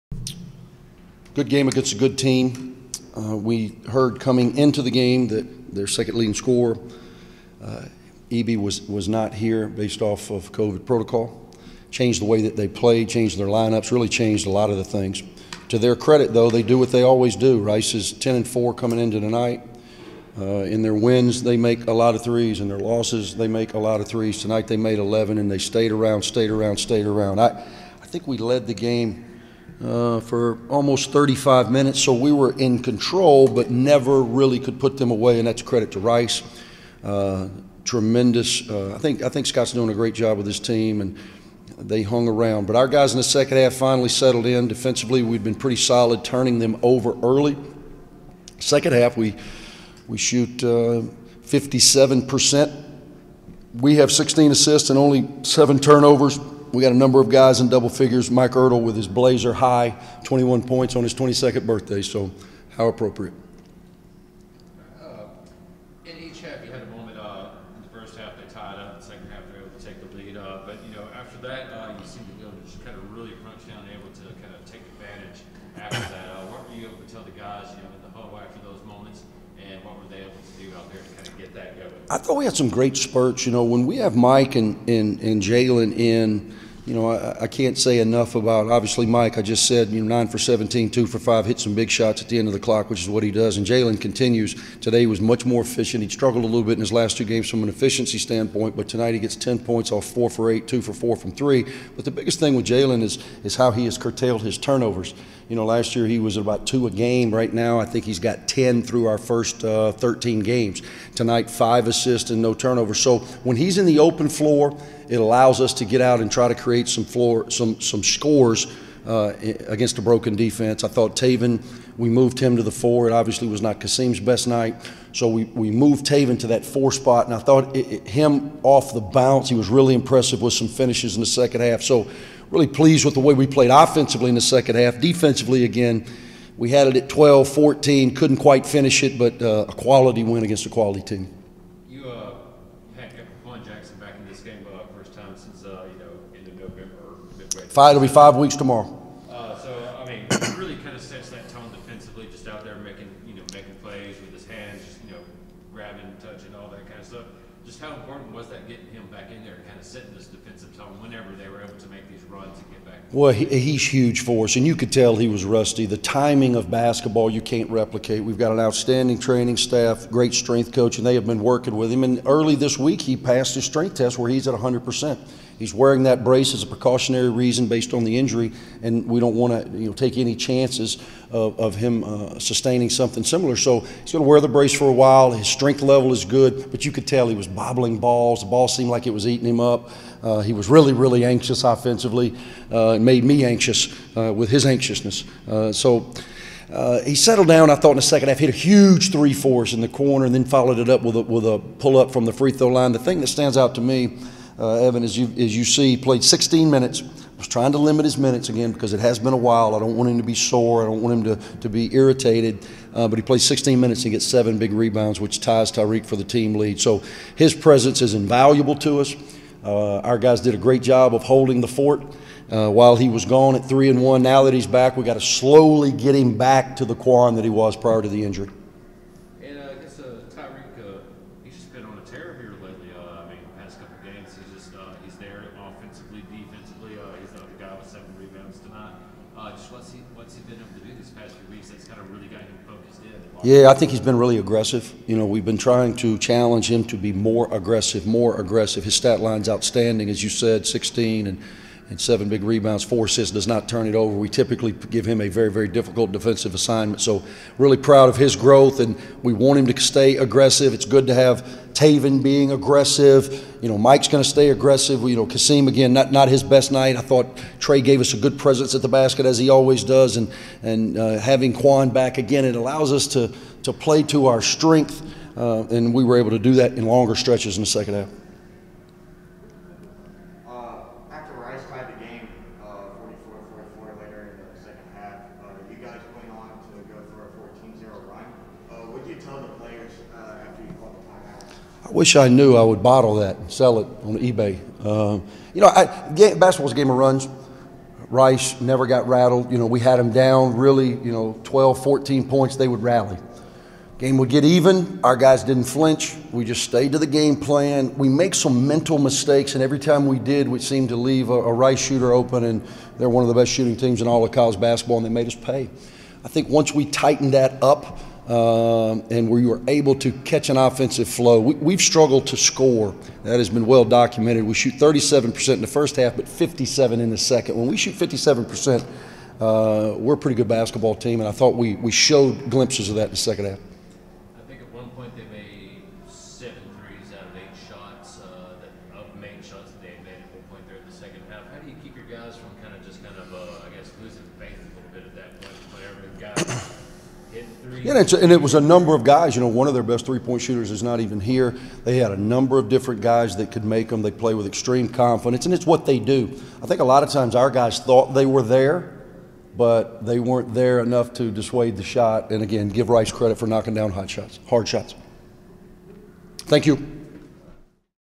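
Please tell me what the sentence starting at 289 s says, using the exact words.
the players uh, after you the I wish I knew I would bottle that and sell it on eBay.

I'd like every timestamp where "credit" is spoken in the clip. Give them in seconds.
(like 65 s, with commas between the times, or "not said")
15 s, 35 s, 363 s.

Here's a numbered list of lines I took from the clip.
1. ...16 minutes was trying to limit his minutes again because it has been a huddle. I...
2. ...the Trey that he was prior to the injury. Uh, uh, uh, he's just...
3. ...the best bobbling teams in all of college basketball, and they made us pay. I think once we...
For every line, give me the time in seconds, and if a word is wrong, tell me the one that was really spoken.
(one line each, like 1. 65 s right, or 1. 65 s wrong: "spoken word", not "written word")
1. 206 s wrong: "while", not "huddle"
2. 226 s wrong: "Quan", not "Trey"
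3. 313 s wrong: "shooting", not "bobbling".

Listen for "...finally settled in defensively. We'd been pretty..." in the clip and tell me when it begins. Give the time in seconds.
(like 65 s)
43 s.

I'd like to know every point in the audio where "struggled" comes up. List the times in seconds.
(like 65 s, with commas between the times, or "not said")
96 s, 321 s.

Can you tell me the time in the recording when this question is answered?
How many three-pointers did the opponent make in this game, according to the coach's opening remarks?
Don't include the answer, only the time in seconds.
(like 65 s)
24 s.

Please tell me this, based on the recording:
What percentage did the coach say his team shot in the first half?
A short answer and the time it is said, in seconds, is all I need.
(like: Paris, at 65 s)
37%, at 324 s.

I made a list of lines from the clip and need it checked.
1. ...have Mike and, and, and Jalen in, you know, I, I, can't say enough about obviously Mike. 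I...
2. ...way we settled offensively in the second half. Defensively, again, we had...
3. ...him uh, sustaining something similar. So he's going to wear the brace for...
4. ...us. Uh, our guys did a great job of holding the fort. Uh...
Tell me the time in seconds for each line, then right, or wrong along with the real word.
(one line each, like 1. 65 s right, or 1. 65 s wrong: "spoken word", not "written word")
1. 83 s right
2. 133 s wrong: "played", not "settled"
3. 181 s right
4. 218 s right.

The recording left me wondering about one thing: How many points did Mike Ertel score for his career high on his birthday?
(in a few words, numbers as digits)
21.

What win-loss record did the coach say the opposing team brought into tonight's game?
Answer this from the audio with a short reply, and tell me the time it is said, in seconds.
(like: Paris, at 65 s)
10-4, at 18 s.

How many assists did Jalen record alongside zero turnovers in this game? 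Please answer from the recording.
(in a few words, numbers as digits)
5.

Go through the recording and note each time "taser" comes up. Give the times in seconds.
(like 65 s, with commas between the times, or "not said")
not said.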